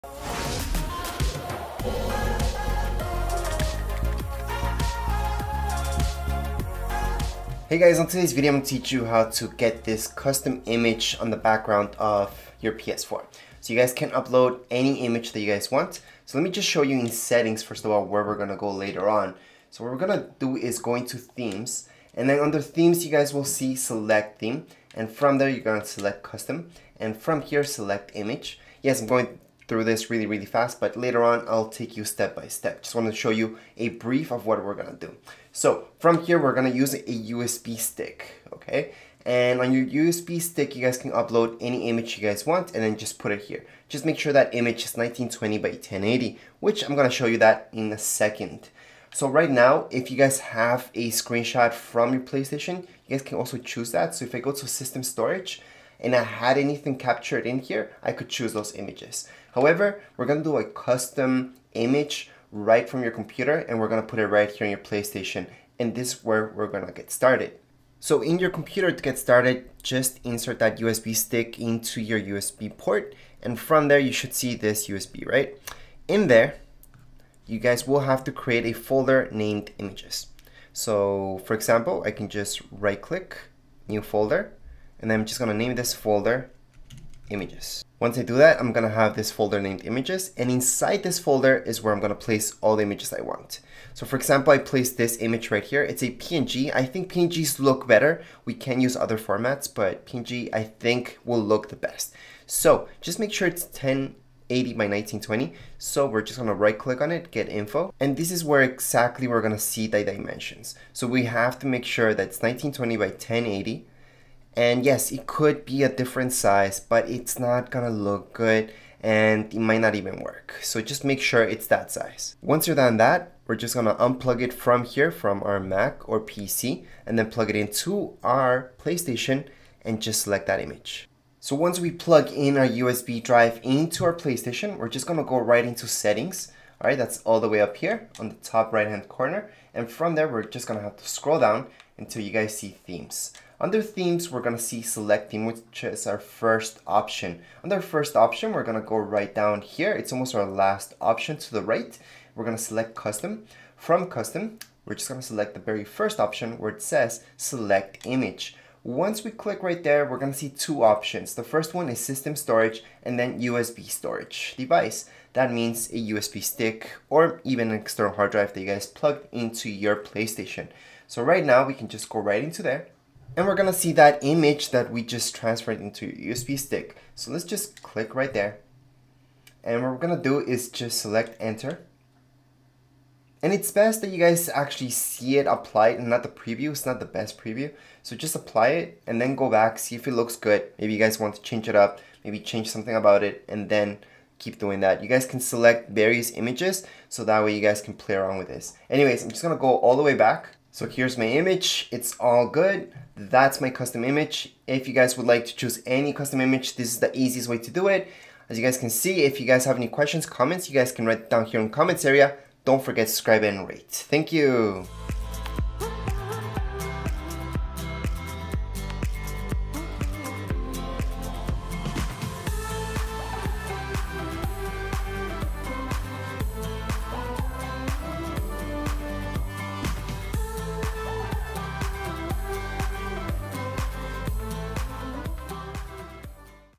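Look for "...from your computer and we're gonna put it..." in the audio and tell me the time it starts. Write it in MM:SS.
01:02.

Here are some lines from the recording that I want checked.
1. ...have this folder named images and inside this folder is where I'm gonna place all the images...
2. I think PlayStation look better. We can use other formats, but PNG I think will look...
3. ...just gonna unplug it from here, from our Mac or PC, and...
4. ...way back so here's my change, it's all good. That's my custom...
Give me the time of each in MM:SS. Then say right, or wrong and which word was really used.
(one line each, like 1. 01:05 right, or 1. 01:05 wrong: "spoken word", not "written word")
1. 01:28 right
2. 01:36 wrong: "PNGs", not "PlayStation"
3. 02:03 right
4. 03:20 wrong: "image", not "change".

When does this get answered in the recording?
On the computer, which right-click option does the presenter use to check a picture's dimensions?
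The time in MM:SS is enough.
01:47.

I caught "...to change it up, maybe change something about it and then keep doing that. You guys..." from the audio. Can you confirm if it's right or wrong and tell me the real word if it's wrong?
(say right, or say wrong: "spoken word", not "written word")
right.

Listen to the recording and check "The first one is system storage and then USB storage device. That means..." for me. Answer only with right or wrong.
right.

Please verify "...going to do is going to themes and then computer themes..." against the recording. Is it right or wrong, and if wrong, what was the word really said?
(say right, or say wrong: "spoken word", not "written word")
wrong: "under", not "computer".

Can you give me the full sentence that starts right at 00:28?
Yes, I'm going through this really, really fast, but later on I'll take you step by step.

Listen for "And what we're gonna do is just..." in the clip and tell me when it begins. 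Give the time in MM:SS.
02:59.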